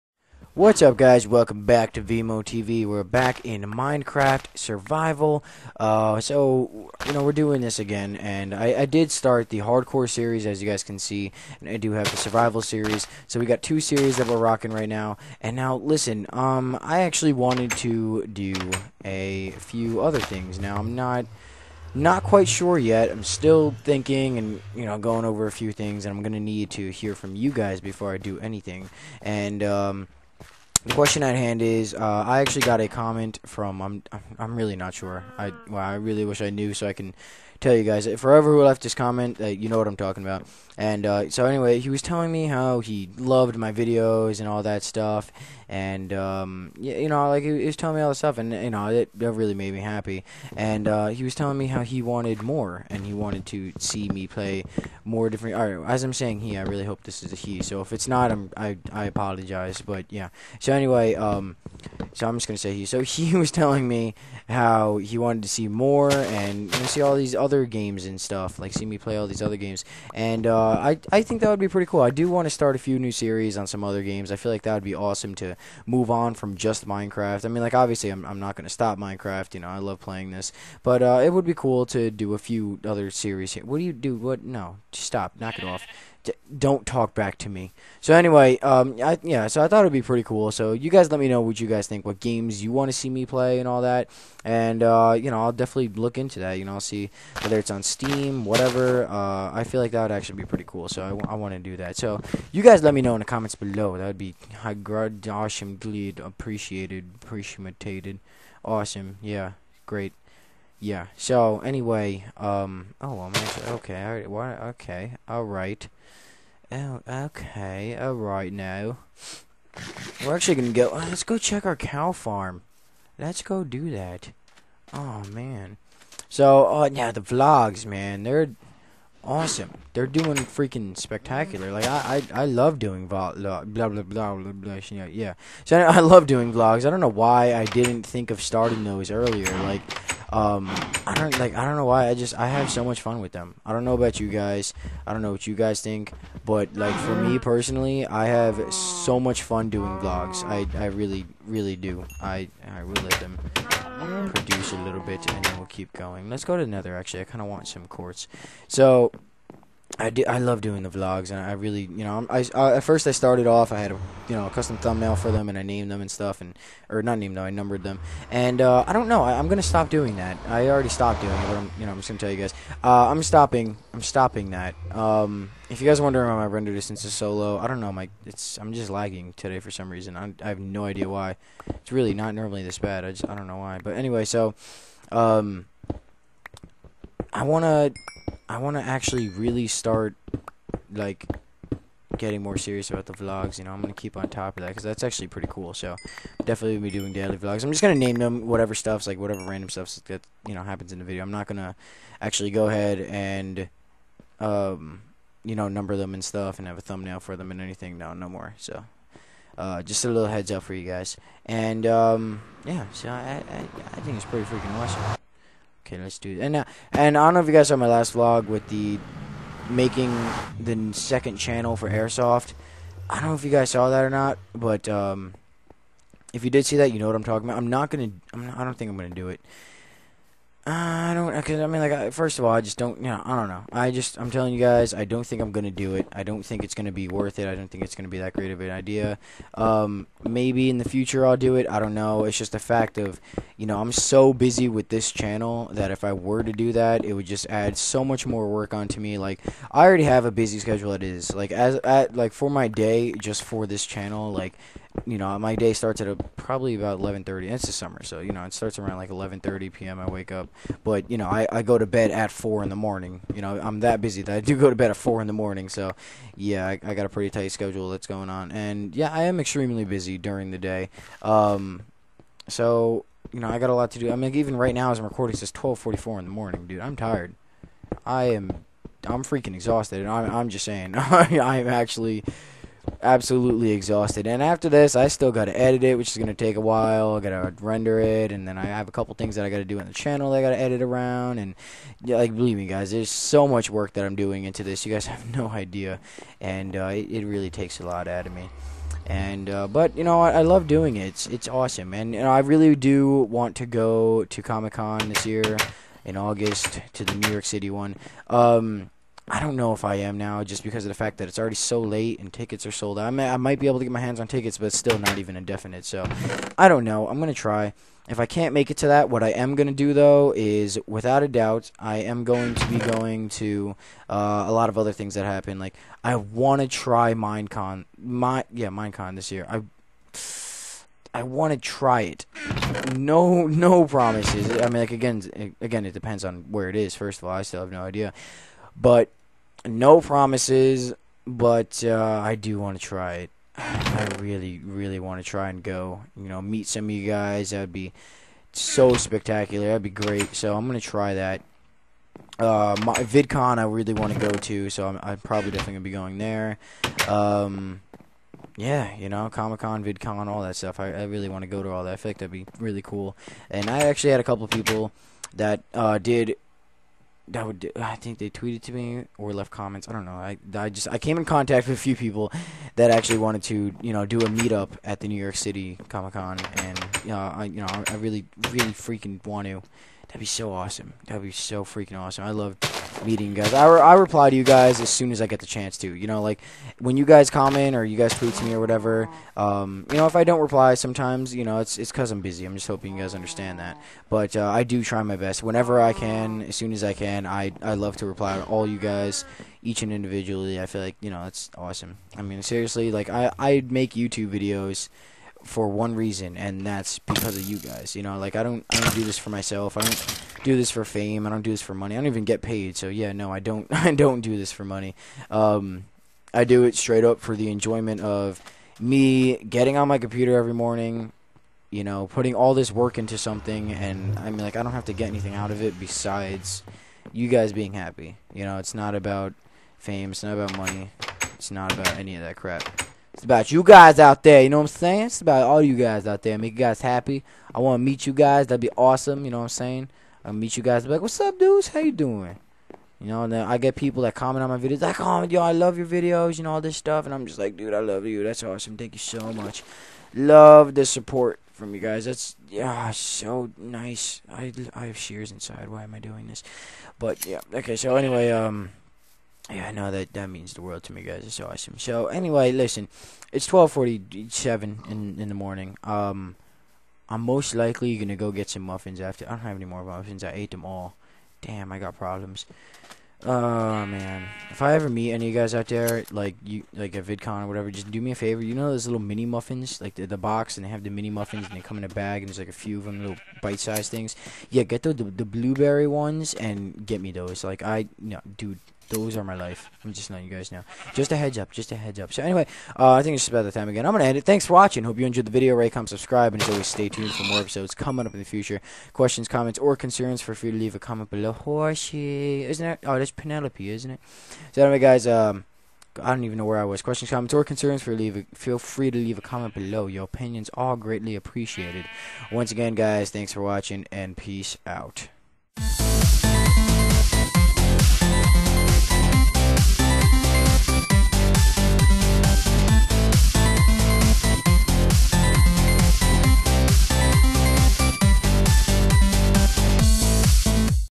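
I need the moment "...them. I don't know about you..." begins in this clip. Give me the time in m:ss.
2:23.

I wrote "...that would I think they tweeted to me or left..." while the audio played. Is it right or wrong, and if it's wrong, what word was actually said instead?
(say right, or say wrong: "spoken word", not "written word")
right.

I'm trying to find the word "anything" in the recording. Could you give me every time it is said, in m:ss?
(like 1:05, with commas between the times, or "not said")
0:28, 3:27, 7:05.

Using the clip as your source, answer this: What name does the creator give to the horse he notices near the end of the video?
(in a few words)
Penelope.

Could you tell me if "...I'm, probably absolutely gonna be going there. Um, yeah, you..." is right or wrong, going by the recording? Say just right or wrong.
wrong.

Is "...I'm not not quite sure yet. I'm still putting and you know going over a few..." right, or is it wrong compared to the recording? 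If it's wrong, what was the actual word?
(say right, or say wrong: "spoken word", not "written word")
wrong: "thinking", not "putting".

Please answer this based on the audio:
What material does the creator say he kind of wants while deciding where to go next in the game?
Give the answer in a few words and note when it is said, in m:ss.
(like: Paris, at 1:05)
quartz, at 2:37.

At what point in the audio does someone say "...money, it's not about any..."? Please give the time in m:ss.
7:10.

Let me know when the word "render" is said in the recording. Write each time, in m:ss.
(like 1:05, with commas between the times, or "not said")
2:56, 4:47.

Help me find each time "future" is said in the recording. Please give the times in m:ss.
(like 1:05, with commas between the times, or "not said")
4:00, 8:18.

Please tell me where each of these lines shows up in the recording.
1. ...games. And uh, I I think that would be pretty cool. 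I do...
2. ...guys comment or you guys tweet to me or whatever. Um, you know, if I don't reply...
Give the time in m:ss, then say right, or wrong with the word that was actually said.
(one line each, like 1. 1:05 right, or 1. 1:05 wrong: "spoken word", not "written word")
1. 1:09 right
2. 6:27 right.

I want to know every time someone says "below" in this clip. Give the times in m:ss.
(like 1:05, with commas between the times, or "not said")
1:43, 8:21, 8:29.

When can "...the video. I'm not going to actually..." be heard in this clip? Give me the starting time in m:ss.
3:20.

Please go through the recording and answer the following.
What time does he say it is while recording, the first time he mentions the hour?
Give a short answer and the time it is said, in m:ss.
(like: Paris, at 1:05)
12:44, at 4:35.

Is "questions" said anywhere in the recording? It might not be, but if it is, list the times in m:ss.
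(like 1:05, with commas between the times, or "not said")
0:30, 8:18, 8:26.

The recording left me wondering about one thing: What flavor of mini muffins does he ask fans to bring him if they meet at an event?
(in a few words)
blueberry.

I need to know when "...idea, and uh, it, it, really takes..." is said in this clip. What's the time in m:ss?
4:55.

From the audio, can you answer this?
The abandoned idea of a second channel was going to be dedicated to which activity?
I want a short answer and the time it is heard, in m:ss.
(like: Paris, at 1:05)
airsoft, at 3:41.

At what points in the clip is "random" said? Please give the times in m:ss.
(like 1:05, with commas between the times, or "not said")
3:19.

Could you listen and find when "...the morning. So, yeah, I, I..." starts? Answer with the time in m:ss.
4:25.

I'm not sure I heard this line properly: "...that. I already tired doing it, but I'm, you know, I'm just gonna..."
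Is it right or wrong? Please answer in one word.
wrong.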